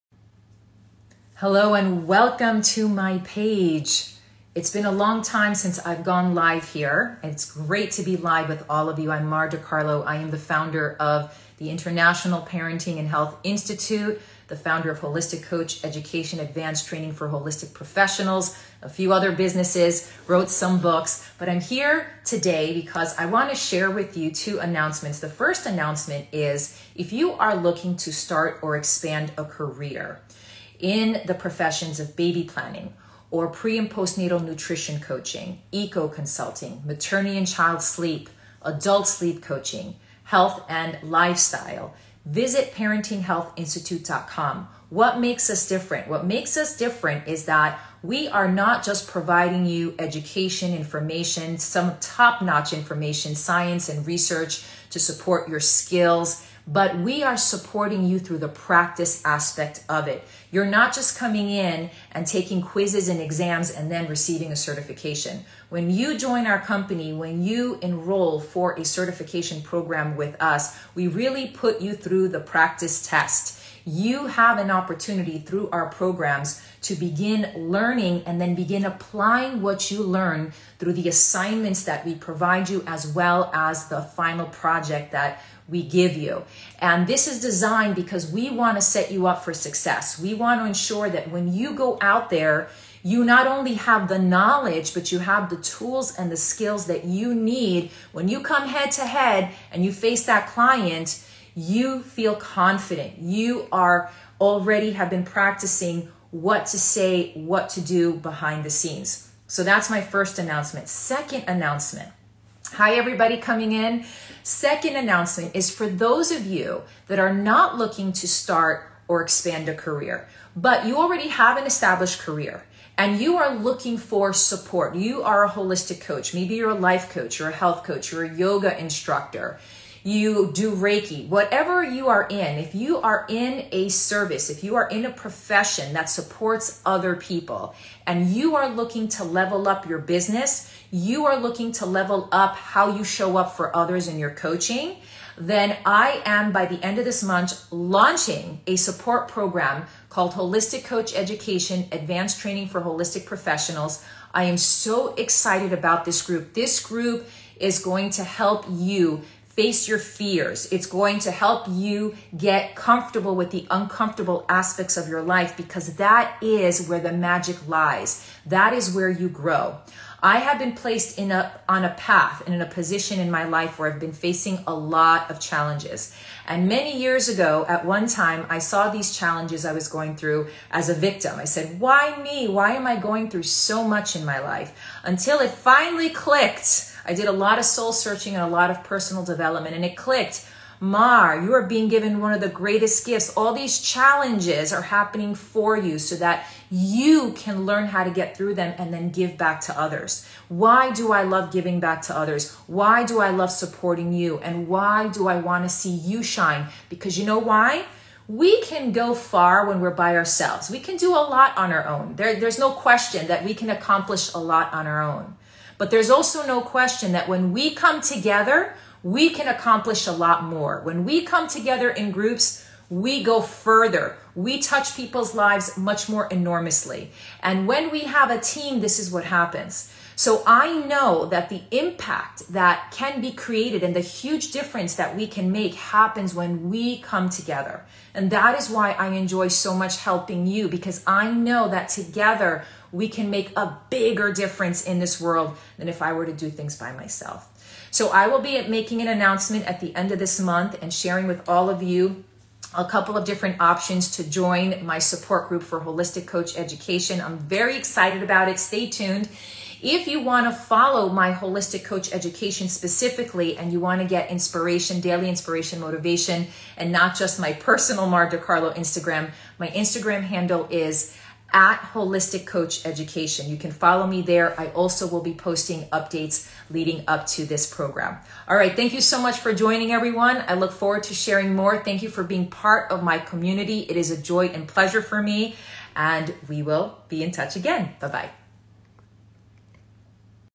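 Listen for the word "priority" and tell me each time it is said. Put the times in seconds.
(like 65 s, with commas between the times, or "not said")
not said.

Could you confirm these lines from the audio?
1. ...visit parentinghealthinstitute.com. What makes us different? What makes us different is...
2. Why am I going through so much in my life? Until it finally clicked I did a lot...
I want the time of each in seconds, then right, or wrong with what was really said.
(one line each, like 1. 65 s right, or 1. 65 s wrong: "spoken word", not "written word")
1. 42 s right
2. 182 s right.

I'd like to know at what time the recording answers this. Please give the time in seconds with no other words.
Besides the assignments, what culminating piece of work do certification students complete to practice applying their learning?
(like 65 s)
84 s.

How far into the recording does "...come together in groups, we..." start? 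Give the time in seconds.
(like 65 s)
221 s.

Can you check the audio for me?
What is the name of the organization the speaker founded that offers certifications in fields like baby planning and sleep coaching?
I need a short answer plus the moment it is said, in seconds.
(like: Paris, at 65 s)
International Parenting and Health Institute, at 11 s.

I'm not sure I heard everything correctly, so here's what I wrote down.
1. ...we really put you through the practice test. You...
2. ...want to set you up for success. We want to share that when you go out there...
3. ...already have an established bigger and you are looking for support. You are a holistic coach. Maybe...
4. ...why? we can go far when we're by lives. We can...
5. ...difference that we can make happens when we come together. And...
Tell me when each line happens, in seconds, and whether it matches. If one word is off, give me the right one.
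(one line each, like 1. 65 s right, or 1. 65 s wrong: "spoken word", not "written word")
1. 70 s right
2. 88 s wrong: "ensure", not "share"
3. 120 s wrong: "career", not "bigger"
4. 207 s wrong: "ourselves", not "lives"
5. 234 s right.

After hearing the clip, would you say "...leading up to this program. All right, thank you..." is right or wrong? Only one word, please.
right.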